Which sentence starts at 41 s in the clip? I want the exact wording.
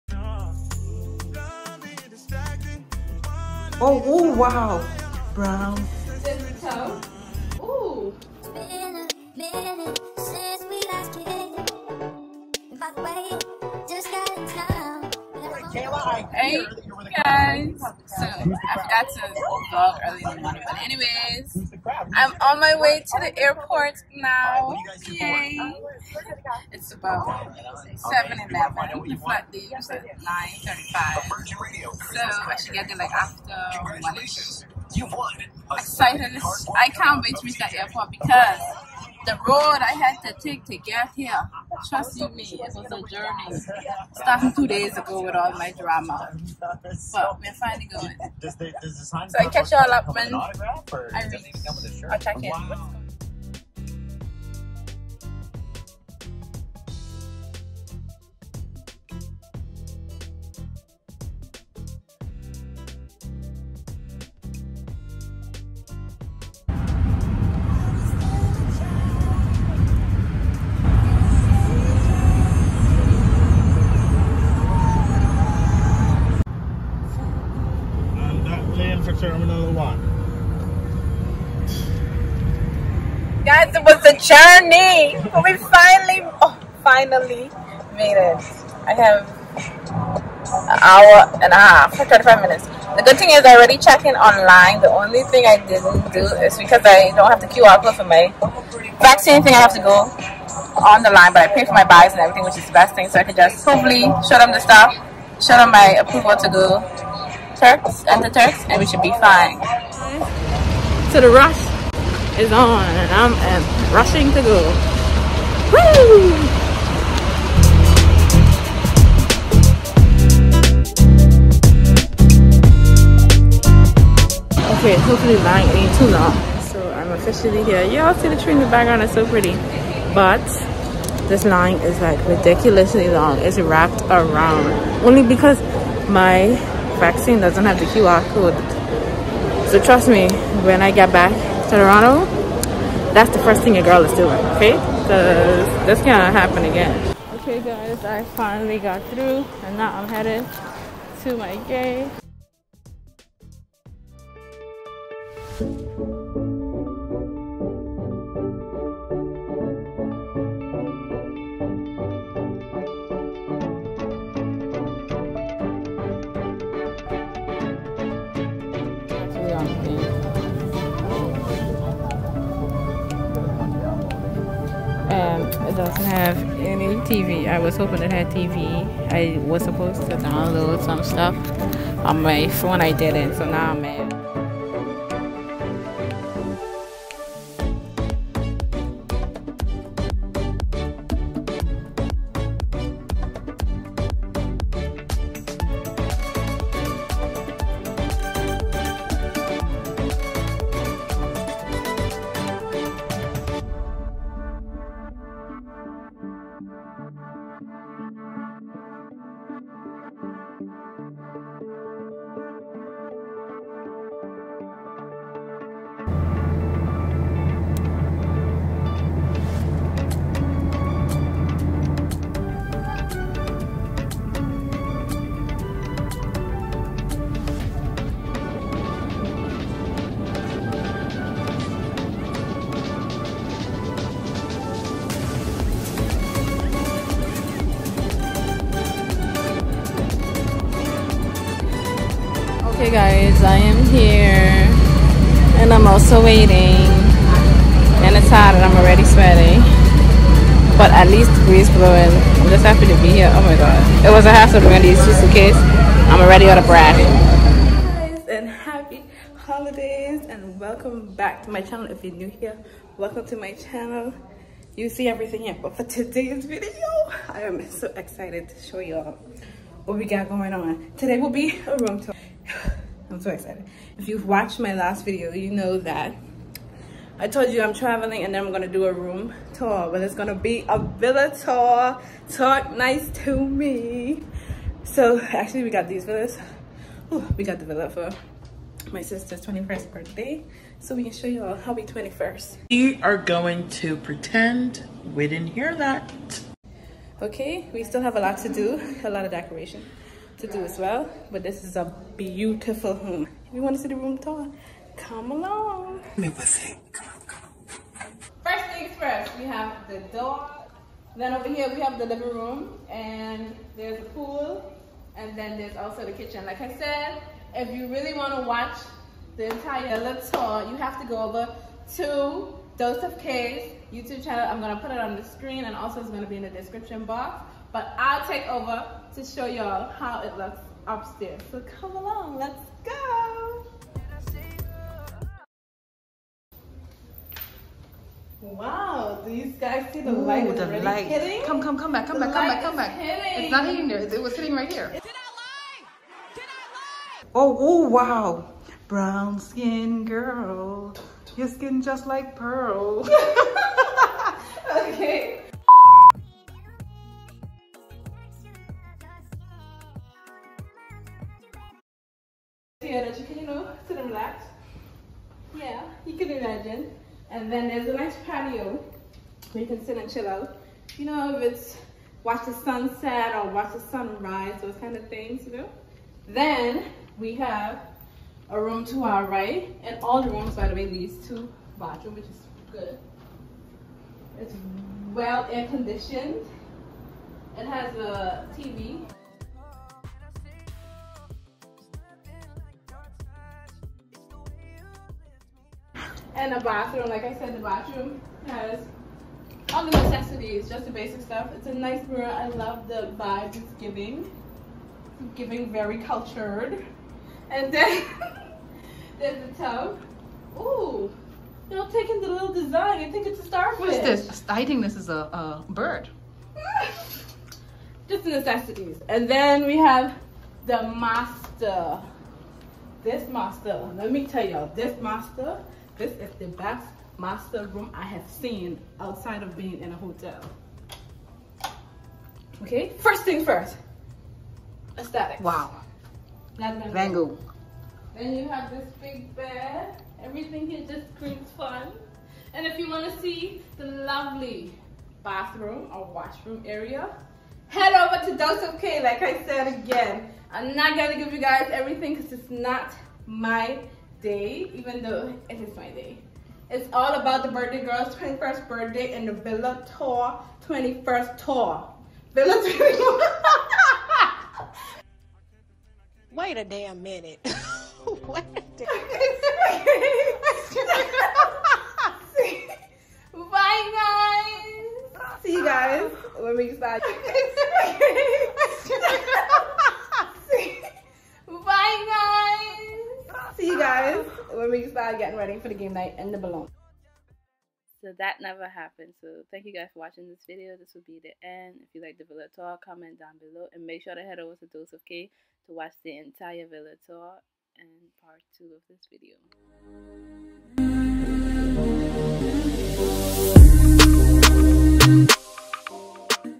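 Trust you me, it was a journey.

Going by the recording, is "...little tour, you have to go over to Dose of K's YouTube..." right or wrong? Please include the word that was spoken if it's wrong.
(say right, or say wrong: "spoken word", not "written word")
right.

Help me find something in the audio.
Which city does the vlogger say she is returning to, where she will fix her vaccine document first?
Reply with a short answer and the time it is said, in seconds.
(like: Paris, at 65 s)
Toronto, at 141 s.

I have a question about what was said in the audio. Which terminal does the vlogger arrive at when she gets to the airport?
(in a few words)
Terminal 1.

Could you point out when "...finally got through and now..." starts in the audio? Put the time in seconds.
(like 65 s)
148 s.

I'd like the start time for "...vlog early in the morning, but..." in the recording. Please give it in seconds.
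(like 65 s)
19 s.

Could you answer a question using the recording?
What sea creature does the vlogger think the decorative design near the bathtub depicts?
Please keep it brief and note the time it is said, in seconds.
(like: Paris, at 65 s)
Starfish, at 413 s.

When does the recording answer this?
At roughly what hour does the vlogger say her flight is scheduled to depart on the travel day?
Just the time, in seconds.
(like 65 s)
28 s.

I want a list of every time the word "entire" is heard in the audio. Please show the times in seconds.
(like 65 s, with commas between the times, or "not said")
319 s, 496 s.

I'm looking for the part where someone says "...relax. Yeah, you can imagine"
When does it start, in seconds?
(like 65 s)
364 s.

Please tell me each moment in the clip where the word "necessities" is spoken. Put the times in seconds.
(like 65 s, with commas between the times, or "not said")
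399 s, 418 s.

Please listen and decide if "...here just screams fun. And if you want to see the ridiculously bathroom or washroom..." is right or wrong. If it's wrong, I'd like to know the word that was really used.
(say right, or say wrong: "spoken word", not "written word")
wrong: "lovely", not "ridiculously".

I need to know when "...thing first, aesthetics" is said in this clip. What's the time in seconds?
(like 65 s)
433 s.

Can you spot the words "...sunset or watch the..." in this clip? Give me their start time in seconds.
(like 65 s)
372 s.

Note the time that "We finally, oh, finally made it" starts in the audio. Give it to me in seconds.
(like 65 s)
85 s.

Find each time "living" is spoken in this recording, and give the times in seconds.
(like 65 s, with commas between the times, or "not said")
312 s.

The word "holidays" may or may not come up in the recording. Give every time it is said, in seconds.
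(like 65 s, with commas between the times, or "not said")
259 s.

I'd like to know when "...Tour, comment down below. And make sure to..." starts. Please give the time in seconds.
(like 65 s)
492 s.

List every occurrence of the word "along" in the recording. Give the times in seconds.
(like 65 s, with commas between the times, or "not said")
305 s, 331 s.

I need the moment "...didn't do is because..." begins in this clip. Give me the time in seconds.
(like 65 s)
95 s.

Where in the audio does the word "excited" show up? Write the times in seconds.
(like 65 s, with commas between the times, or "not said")
35 s, 267 s, 273 s.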